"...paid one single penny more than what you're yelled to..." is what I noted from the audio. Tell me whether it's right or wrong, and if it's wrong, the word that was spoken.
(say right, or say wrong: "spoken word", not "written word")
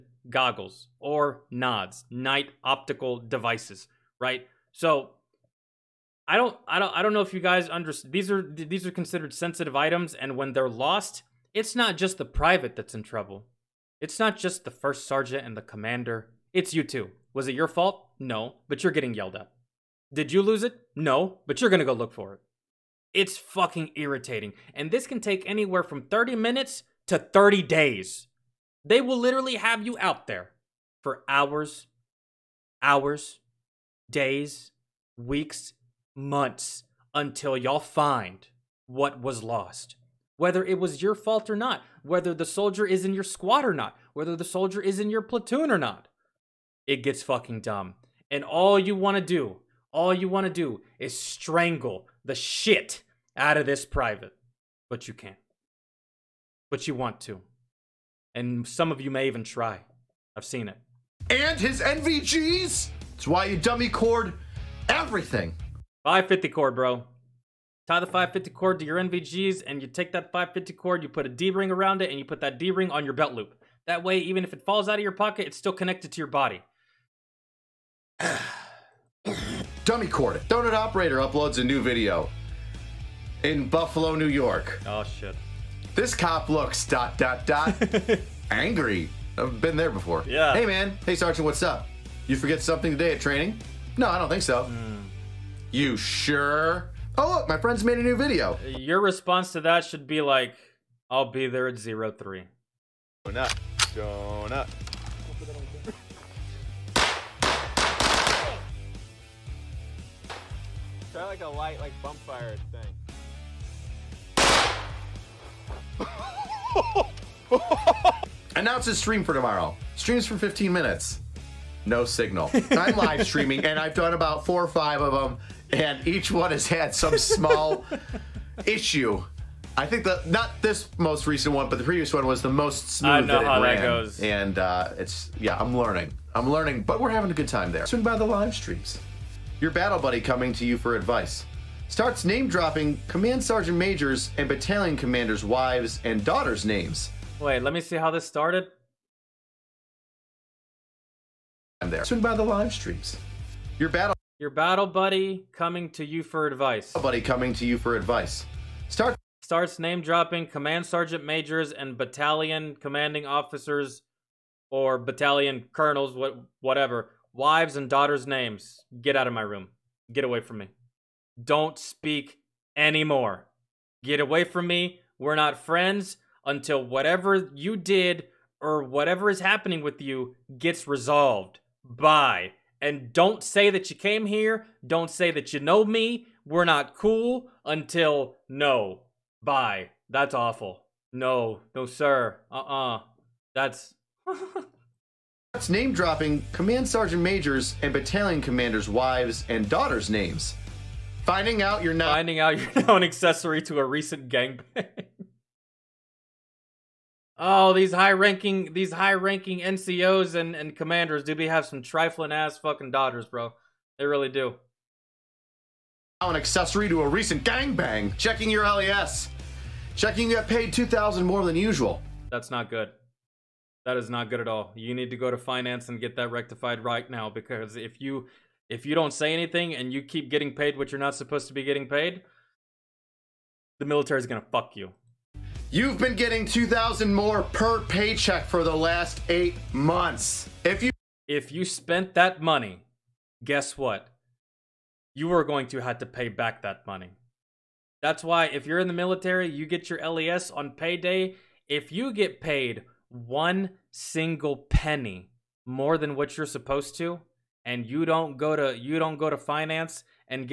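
wrong: "supposed", not "yelled".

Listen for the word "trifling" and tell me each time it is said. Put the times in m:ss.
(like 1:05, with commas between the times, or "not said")
3:31.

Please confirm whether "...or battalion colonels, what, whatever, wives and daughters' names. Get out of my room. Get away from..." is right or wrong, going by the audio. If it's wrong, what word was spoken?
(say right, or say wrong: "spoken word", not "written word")
right.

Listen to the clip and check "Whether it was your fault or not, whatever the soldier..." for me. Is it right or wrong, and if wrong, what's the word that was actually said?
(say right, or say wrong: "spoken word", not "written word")
wrong: "whether", not "whatever".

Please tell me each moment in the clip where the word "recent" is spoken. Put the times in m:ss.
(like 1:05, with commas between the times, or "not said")
2:11, 3:23, 3:37.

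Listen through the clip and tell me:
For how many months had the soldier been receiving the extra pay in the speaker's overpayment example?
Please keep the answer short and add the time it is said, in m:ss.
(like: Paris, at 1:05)
8, at 3:59.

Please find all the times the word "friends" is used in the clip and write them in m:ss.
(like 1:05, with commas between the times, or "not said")
1:37, 2:55.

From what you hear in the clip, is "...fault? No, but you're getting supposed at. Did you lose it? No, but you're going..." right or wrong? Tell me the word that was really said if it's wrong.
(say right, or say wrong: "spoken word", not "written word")
wrong: "yelled", not "supposed".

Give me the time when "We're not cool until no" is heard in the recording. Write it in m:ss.
3:06.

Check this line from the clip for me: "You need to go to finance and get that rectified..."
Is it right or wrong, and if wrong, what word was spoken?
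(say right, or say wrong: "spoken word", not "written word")
right.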